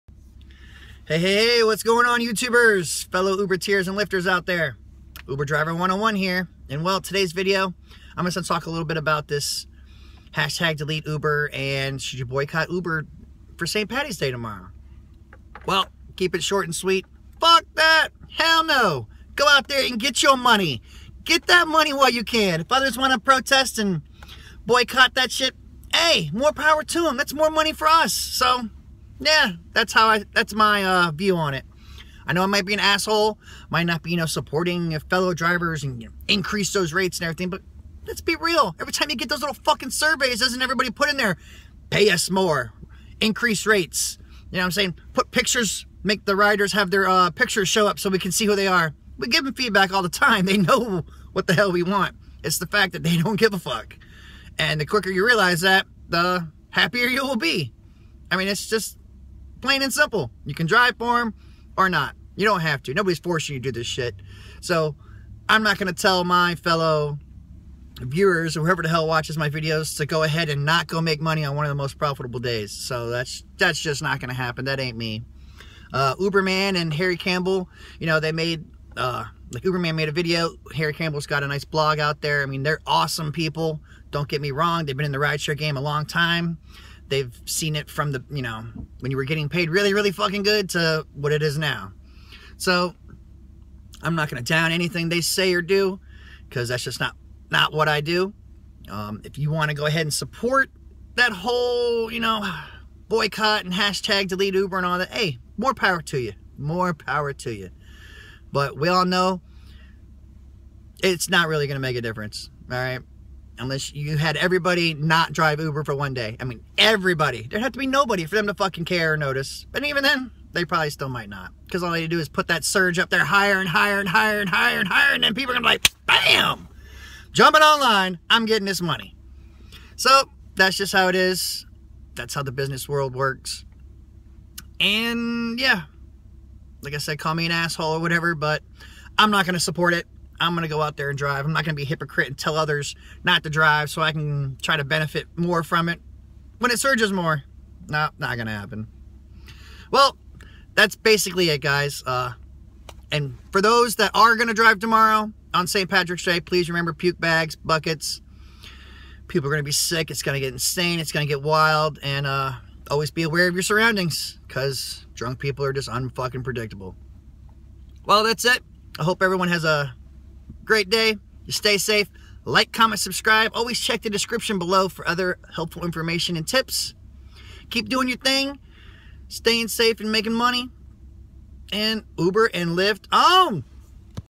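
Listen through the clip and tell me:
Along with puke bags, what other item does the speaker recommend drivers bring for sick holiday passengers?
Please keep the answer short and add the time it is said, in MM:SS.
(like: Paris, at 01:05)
buckets, at 02:37.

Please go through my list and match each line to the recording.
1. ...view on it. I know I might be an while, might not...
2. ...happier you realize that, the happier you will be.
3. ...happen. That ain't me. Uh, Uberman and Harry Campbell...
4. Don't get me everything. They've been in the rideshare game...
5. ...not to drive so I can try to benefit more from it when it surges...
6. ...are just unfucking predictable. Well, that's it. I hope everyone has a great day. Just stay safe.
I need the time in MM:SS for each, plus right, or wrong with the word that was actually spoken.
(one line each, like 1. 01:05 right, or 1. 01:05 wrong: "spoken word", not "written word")
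1. 00:31 wrong: "asshole", not "while"
2. 00:54 wrong: "quicker", not "happier"
3. 01:14 right
4. 01:24 wrong: "wrong", not "everything"
5. 02:23 right
6. 02:45 right.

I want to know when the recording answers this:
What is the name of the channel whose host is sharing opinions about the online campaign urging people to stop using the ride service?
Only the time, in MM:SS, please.
00:05.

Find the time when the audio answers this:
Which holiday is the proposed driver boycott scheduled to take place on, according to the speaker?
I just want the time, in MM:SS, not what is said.
00:13.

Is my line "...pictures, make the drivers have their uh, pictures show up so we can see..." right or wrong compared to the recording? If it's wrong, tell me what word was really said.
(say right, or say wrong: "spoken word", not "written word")
wrong: "riders", not "drivers".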